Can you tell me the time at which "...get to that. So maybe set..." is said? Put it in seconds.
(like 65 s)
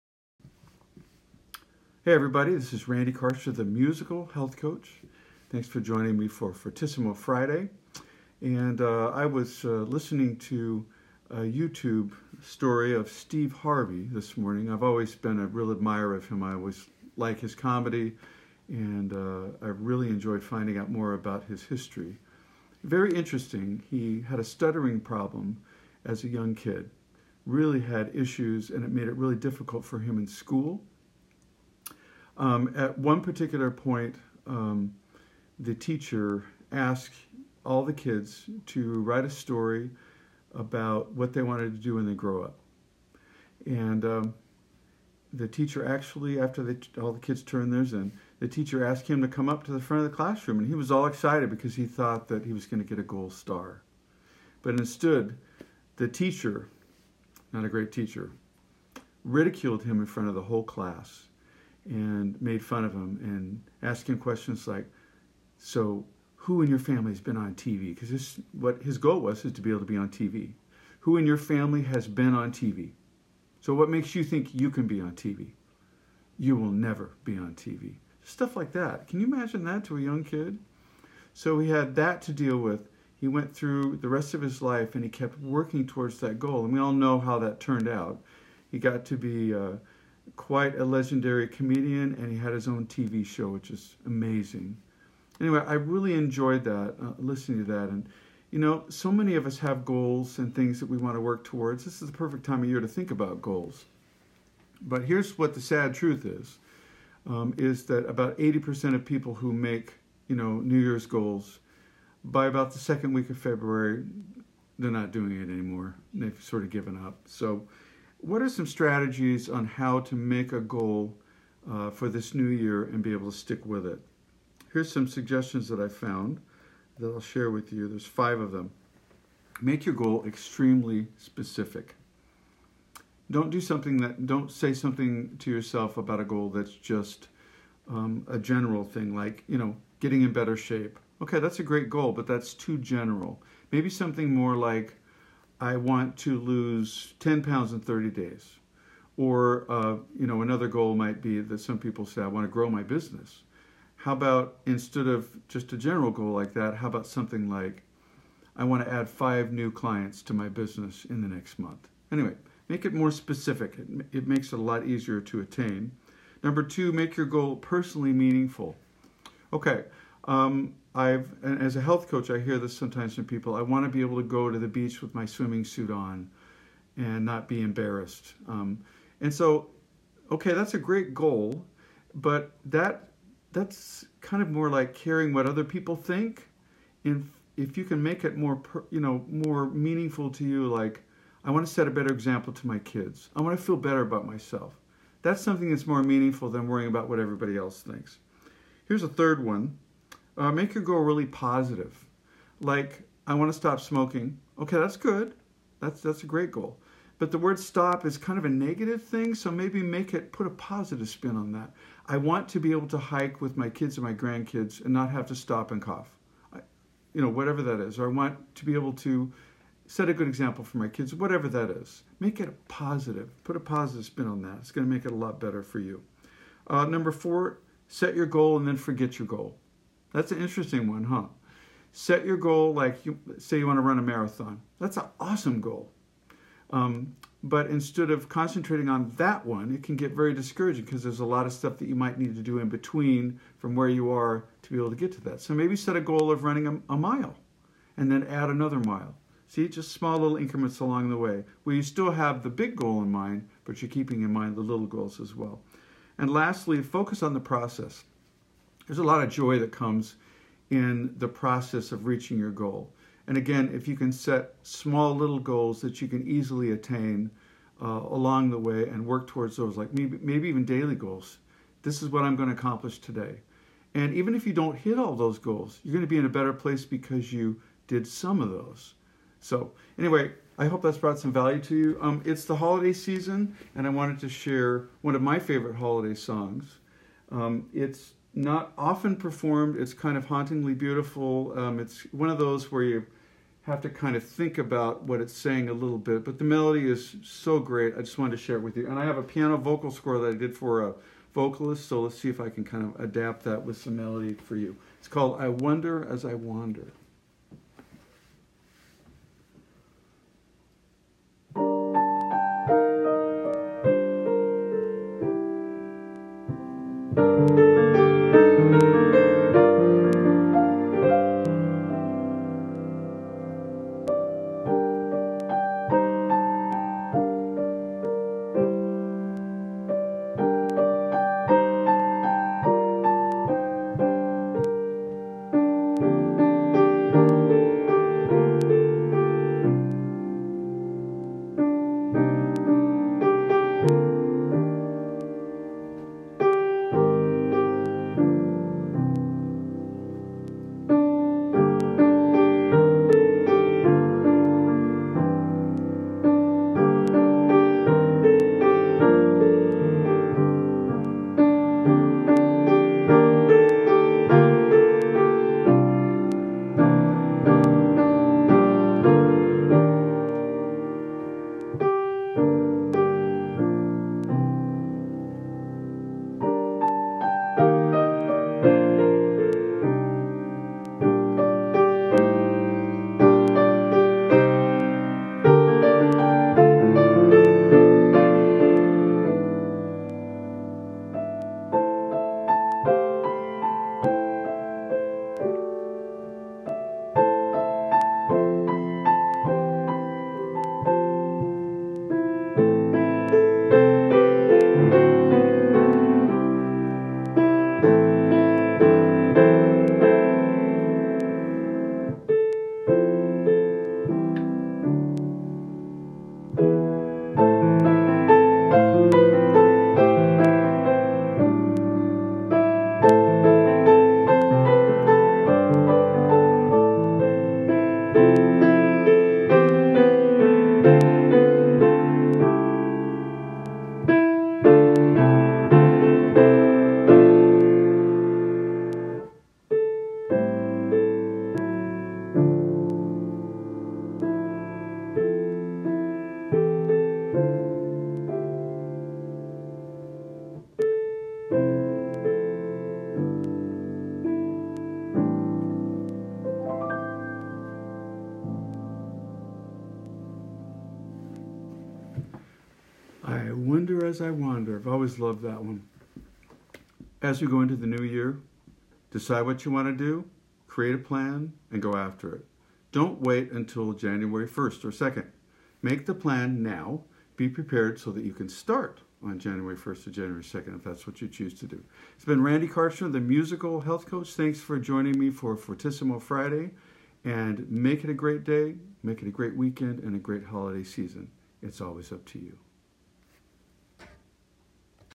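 244 s.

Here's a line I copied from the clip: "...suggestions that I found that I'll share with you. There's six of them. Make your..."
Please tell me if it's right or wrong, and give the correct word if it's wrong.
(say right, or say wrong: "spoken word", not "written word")
wrong: "five", not "six".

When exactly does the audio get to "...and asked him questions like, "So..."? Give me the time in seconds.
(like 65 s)
63 s.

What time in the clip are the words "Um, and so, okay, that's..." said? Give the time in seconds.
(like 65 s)
178 s.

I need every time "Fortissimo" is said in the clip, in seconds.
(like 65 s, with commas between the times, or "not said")
6 s, 485 s.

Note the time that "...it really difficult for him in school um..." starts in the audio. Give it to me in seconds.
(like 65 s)
29 s.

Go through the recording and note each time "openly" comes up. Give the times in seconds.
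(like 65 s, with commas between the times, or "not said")
not said.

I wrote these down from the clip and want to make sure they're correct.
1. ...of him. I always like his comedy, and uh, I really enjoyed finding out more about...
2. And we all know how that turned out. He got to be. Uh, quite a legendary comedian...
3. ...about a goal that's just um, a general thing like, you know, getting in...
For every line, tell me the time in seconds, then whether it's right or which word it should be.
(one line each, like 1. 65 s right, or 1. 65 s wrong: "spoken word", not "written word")
1. 16 s right
2. 86 s right
3. 135 s right.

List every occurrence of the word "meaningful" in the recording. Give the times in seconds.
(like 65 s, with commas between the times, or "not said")
168 s, 189 s, 196 s.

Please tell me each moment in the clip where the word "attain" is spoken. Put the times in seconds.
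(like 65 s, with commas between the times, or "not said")
165 s, 266 s.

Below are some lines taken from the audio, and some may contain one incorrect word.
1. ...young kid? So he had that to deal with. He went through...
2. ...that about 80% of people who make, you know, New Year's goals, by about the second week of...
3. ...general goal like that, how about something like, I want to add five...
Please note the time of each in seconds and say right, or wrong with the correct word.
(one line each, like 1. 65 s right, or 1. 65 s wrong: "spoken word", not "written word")
1. 80 s right
2. 107 s right
3. 155 s right.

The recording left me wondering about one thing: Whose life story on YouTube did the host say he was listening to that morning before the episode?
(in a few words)
Steve Harvey.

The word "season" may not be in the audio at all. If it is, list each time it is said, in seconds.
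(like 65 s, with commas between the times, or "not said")
282 s, 490 s.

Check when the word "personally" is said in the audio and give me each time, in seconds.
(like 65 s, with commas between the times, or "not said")
167 s.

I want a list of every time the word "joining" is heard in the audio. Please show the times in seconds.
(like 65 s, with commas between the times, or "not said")
5 s, 484 s.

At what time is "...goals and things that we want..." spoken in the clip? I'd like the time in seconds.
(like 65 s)
99 s.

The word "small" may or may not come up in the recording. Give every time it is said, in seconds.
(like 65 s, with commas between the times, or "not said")
249 s, 264 s.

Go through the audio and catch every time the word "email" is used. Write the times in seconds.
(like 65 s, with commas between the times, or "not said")
not said.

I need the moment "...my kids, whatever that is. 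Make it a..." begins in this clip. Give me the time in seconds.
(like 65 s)
220 s.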